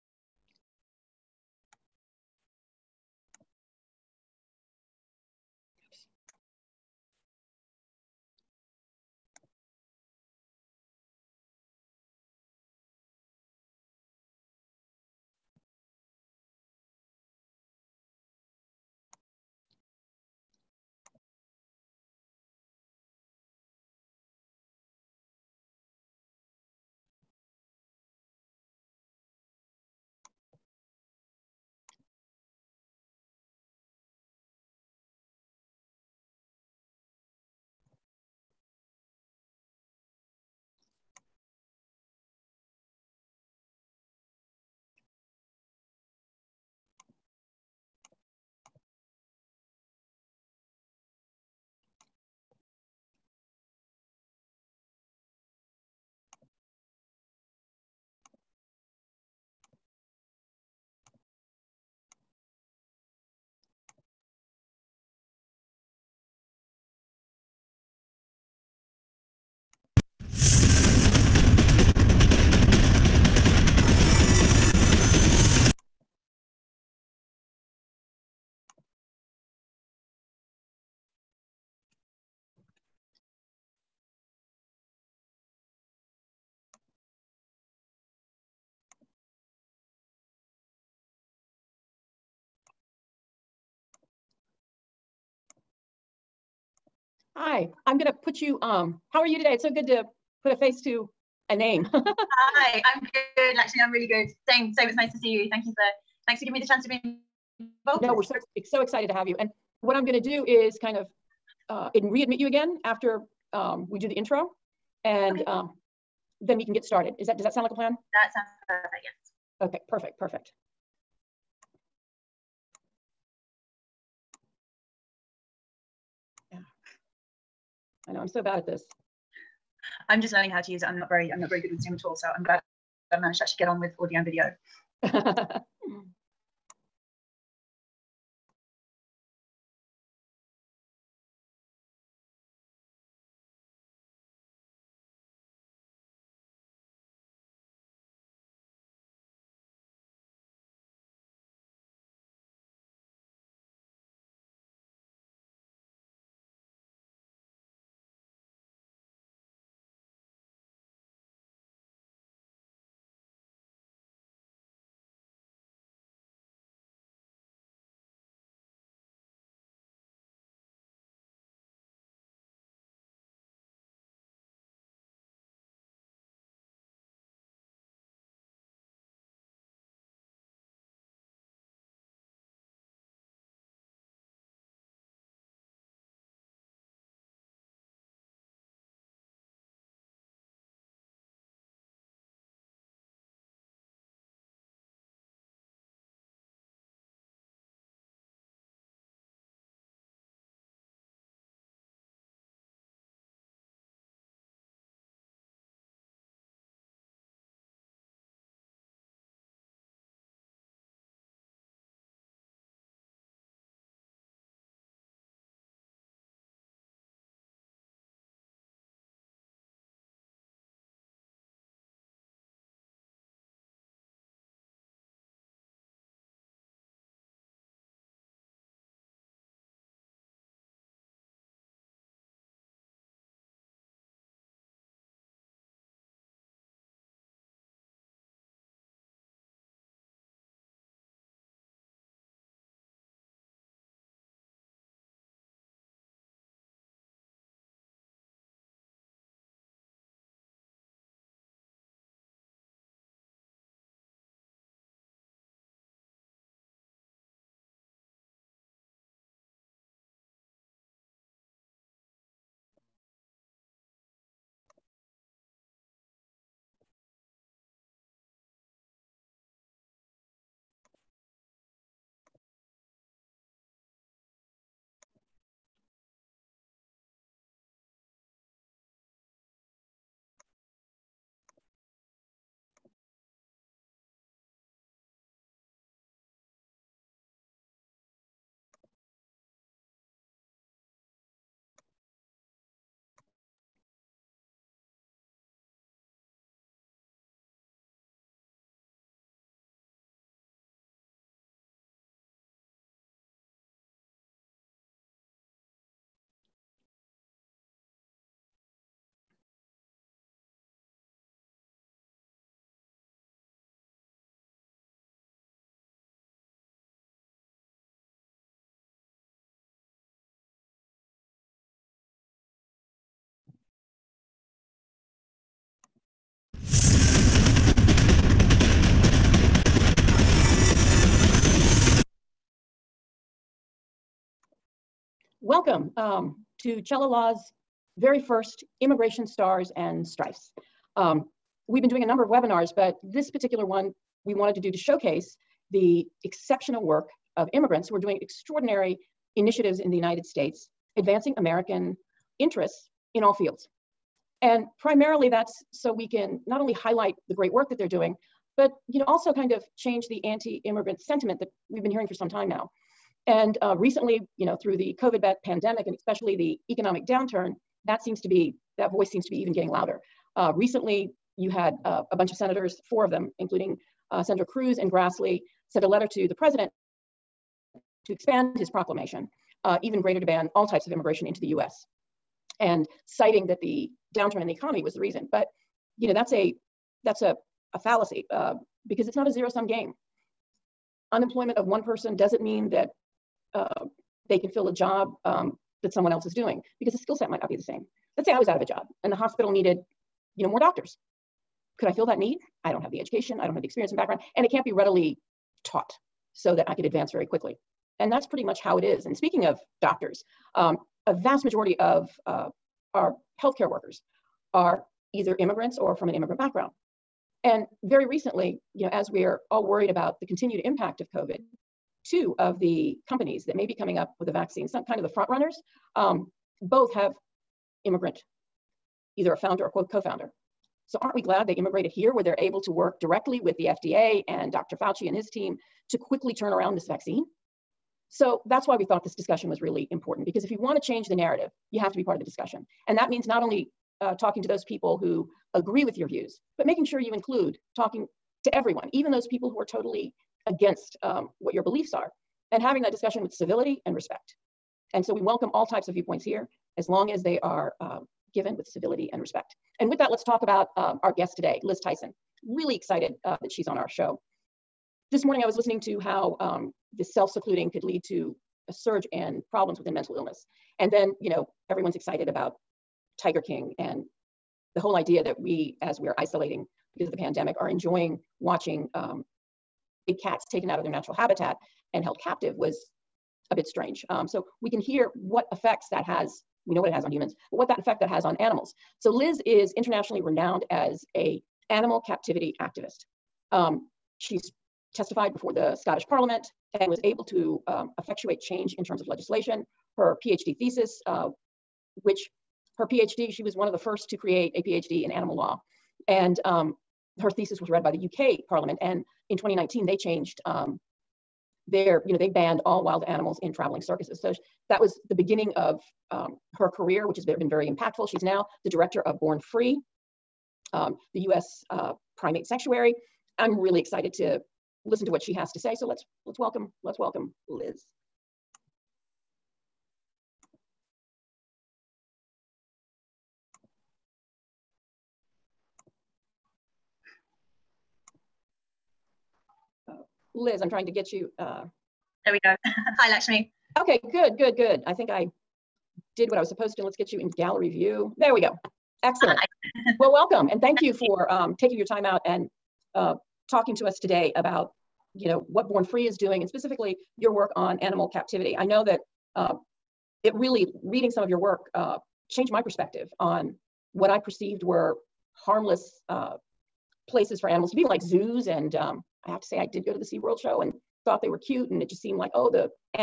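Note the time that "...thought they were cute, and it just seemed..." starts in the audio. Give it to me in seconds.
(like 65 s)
571 s.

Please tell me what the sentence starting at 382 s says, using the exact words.
And citing that the downturn in the economy was the reason.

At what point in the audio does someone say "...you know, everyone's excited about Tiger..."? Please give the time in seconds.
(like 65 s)
471 s.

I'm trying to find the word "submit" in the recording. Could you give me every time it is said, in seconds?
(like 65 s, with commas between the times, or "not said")
not said.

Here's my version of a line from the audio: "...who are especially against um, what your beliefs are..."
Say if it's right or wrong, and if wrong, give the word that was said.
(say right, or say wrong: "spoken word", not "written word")
wrong: "totally", not "especially".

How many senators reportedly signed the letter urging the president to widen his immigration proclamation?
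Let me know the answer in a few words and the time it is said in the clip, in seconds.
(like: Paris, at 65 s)
4, at 372 s.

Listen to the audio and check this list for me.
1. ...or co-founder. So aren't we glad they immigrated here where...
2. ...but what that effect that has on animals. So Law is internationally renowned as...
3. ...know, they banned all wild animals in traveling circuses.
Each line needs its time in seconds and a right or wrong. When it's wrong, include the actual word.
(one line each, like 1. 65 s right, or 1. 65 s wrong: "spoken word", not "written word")
1. 429 s right
2. 487 s wrong: "Liz", not "Law"
3. 512 s right.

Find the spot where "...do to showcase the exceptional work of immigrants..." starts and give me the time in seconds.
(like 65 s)
344 s.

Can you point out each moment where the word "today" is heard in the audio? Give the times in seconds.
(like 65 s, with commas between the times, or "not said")
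99 s, 461 s, 553 s.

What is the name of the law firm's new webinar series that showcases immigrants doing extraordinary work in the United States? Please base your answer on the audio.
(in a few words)
Immigration Stars and Strifes.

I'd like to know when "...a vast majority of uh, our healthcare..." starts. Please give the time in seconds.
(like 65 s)
411 s.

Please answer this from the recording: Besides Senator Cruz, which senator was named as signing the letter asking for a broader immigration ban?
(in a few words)
Grassley.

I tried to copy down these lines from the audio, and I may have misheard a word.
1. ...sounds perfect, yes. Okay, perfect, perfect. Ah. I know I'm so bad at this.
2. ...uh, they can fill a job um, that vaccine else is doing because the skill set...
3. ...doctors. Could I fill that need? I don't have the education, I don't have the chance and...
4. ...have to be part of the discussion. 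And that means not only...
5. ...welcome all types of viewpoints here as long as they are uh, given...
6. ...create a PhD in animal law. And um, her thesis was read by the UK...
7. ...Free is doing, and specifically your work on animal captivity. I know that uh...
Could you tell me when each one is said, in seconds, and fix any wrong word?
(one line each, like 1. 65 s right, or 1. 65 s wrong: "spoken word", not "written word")
1. 118 s right
2. 393 s wrong: "someone", not "vaccine"
3. 400 s wrong: "experience", not "chance"
4. 441 s right
5. 455 s right
6. 504 s right
7. 555 s right.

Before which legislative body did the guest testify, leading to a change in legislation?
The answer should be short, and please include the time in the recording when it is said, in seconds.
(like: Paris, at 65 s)
Scottish Parliament, at 495 s.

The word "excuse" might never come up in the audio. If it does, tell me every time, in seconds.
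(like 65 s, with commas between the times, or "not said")
not said.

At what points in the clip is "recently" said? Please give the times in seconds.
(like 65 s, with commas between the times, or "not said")
363 s, 370 s, 418 s.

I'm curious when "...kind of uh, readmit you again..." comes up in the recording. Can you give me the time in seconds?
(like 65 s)
110 s.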